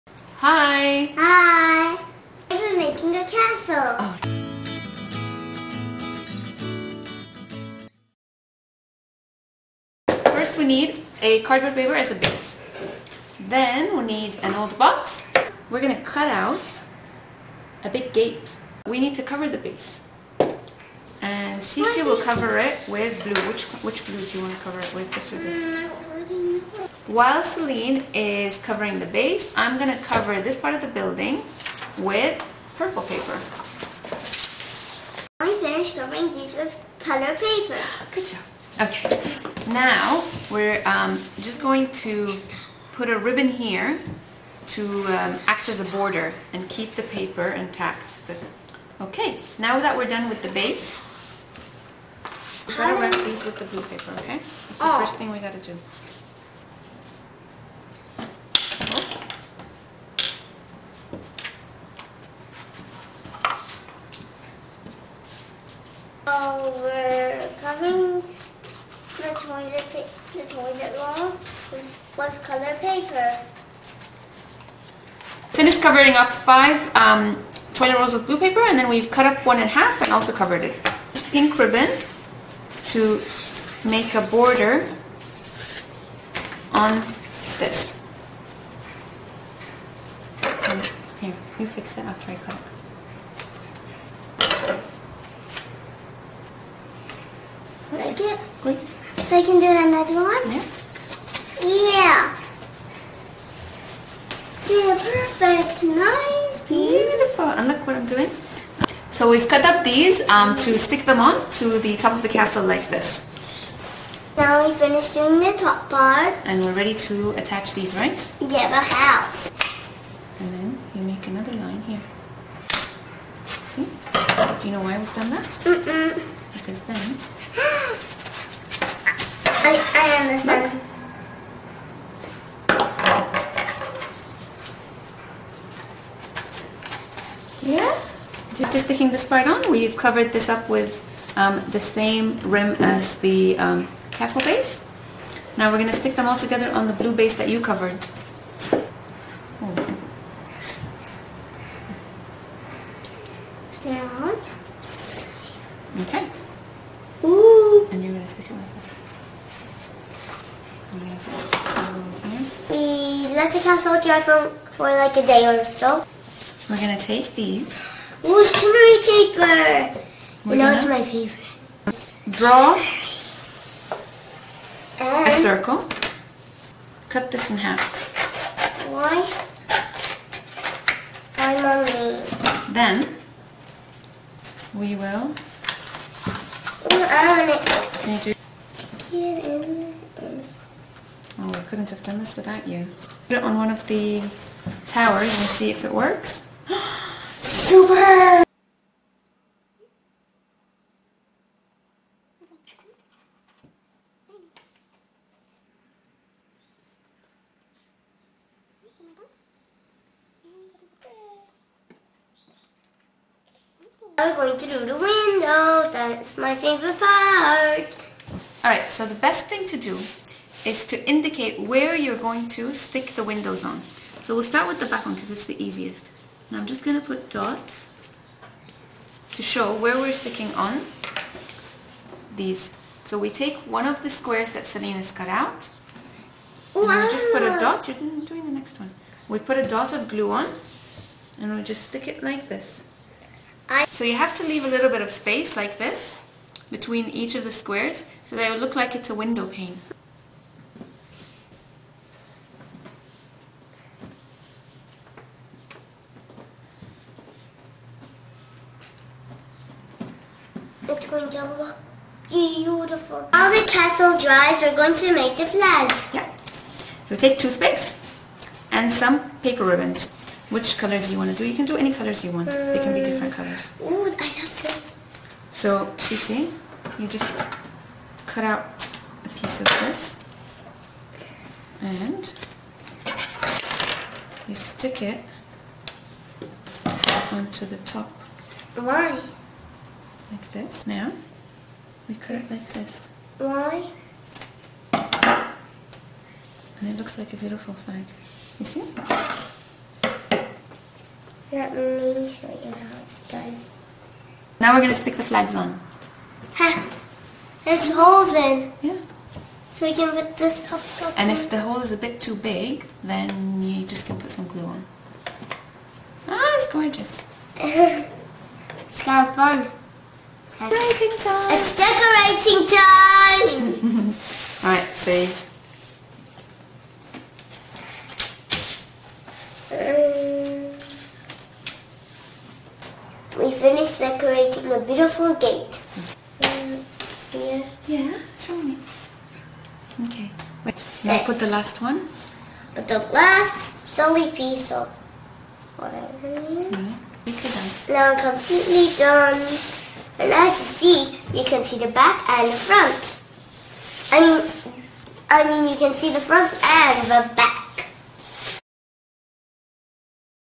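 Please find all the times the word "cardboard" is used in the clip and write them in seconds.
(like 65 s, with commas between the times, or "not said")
11 s.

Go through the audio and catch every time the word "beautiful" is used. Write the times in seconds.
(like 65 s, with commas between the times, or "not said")
106 s, 262 s, 297 s, 334 s.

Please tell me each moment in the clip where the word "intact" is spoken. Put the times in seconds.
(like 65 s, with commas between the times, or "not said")
47 s.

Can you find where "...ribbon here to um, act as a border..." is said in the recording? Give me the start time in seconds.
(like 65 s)
43 s.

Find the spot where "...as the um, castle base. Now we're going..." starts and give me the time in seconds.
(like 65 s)
142 s.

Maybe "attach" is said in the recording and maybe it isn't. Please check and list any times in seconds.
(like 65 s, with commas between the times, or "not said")
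117 s.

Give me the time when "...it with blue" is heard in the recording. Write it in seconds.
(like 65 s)
22 s.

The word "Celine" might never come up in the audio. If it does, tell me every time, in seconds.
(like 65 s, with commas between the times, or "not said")
27 s.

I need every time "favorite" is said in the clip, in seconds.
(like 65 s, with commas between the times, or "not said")
171 s, 216 s.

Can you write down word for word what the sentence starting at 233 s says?
So we take one of the squares that Selena's cut out.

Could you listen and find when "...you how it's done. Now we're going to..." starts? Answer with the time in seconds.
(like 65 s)
302 s.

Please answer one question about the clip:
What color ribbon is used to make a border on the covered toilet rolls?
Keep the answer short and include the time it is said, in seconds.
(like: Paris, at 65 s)
Pink, at 81 s.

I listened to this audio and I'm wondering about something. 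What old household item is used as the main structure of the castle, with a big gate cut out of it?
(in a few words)
An old box.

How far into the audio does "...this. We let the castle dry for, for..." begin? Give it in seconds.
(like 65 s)
158 s.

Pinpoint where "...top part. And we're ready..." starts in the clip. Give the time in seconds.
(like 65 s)
115 s.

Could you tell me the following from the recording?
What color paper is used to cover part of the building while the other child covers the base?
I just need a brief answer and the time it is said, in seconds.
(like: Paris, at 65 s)
Purple, at 32 s.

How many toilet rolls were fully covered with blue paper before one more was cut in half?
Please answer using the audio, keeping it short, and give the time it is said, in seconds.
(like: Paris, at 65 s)
5, at 76 s.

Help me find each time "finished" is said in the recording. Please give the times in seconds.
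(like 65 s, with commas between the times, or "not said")
35 s, 75 s, 114 s, 333 s.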